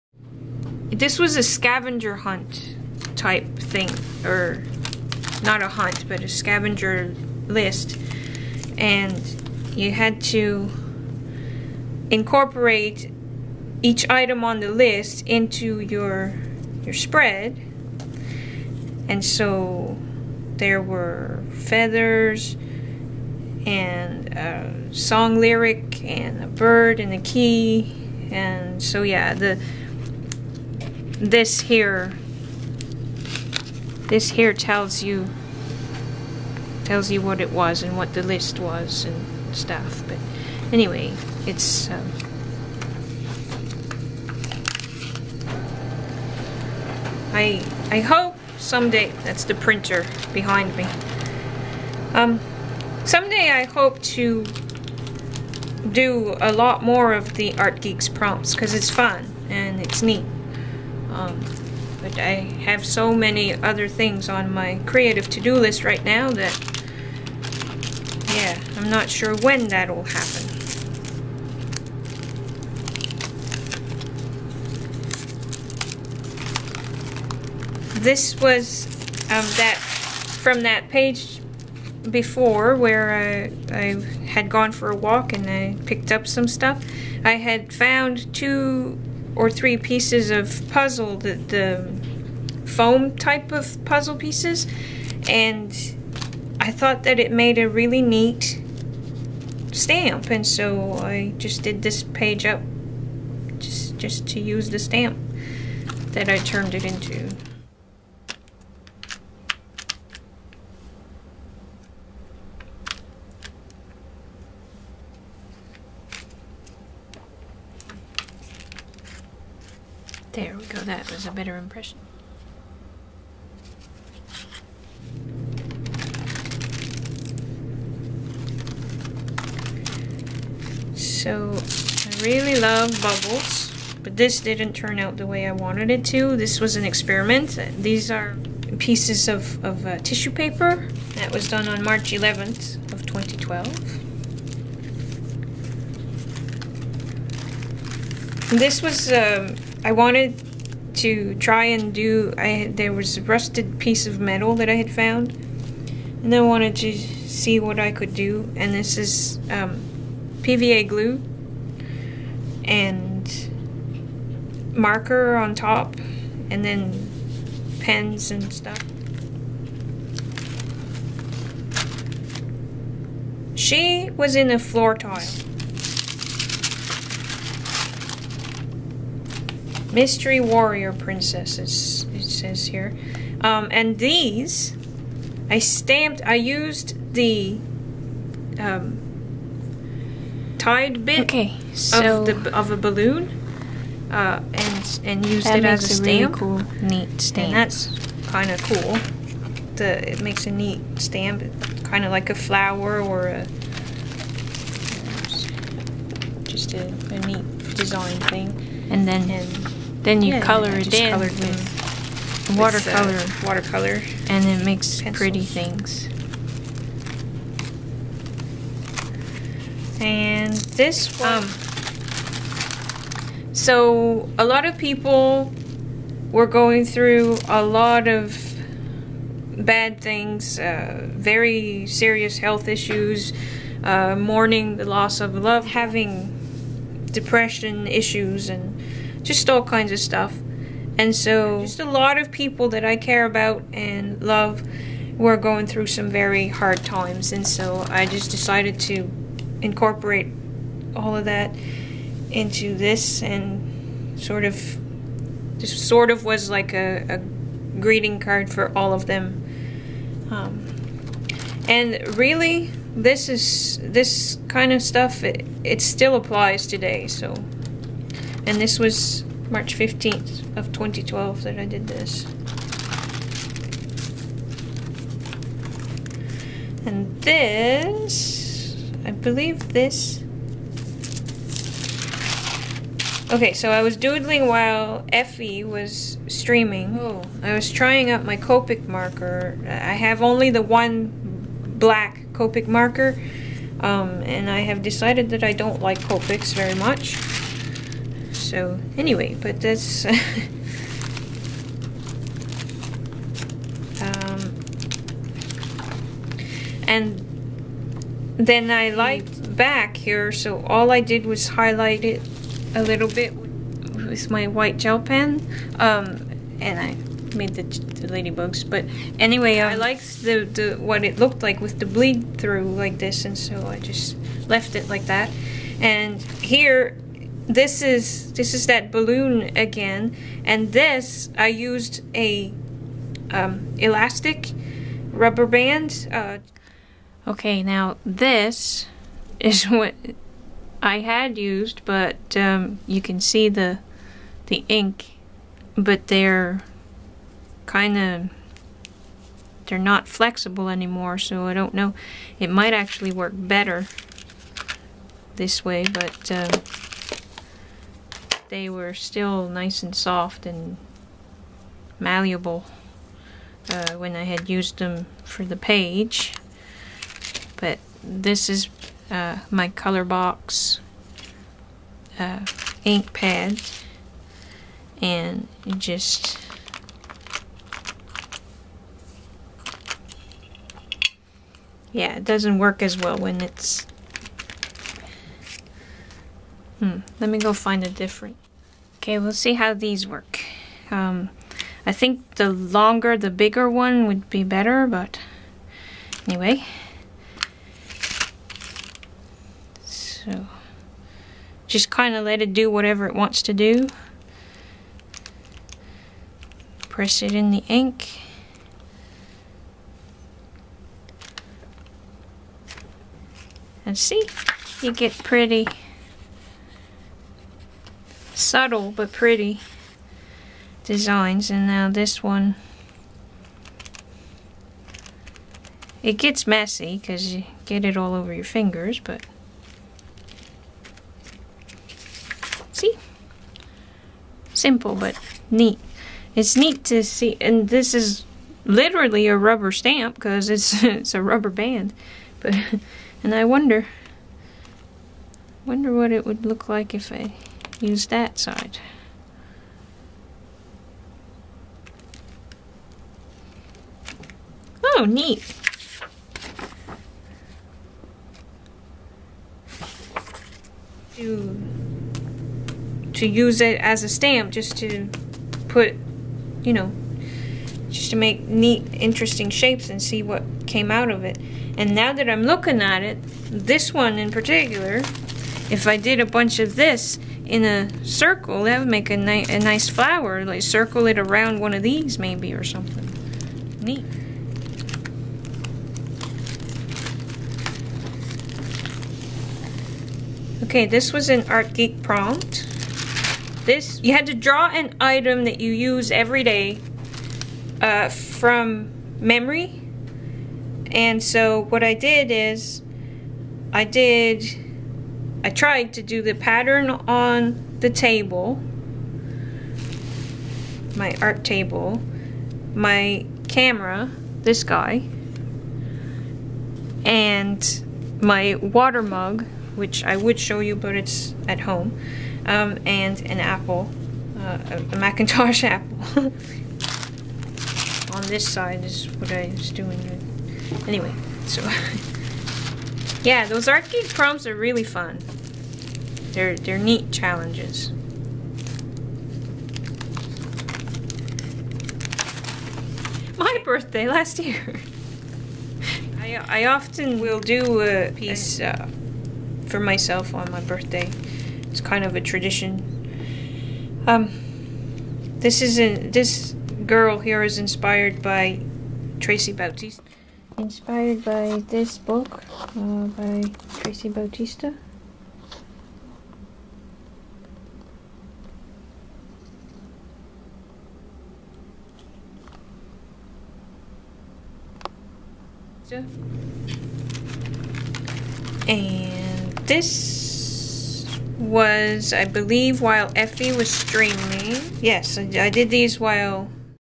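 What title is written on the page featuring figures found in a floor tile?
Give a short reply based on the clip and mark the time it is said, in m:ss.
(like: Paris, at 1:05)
Mystery Warrior Princesses, at 2:59.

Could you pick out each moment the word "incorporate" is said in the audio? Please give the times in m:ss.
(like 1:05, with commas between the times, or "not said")
0:12, 4:09.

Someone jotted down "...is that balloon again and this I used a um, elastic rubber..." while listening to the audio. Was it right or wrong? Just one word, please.
right.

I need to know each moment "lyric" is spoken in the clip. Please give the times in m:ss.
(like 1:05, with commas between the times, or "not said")
0:25.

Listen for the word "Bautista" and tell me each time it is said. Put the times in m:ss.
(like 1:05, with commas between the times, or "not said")
9:19, 9:24.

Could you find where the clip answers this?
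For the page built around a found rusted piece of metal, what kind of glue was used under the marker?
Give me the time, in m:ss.
2:40.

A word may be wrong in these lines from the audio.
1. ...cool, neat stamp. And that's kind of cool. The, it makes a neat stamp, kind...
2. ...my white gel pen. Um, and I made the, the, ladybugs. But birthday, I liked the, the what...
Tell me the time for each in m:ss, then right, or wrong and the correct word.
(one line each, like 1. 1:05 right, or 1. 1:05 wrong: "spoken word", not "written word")
1. 3:16 right
2. 5:14 wrong: "anyway", not "birthday".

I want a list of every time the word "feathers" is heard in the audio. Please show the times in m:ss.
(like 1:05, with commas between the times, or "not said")
0:21.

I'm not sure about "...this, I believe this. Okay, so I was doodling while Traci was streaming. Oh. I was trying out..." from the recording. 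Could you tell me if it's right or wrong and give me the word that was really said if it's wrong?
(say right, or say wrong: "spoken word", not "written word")
wrong: "Effy", not "Traci".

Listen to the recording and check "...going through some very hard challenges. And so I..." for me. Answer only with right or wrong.
wrong.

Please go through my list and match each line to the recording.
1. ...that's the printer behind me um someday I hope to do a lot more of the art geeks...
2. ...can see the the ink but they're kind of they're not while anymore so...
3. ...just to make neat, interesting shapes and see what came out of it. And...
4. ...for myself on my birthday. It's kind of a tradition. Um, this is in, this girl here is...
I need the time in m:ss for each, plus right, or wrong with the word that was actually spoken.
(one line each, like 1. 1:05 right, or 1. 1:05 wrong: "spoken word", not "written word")
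1. 0:49 right
2. 5:43 wrong: "flexible", not "while"
3. 7:47 right
4. 9:09 right.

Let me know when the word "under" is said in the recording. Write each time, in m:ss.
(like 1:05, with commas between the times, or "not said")
not said.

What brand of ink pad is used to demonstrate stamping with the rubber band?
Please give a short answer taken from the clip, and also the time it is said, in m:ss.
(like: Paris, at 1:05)
Color Box, at 6:09.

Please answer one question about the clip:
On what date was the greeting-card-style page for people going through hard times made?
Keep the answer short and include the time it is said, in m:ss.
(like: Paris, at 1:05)
March 15, 2012, at 4:29.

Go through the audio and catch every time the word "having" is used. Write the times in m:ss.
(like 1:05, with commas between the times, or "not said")
3:55.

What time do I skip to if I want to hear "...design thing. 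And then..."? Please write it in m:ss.
3:27.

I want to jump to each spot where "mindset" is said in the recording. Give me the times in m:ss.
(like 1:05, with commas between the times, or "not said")
not said.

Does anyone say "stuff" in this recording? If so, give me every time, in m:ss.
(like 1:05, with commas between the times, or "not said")
0:39, 1:26, 2:48, 3:59, 4:24.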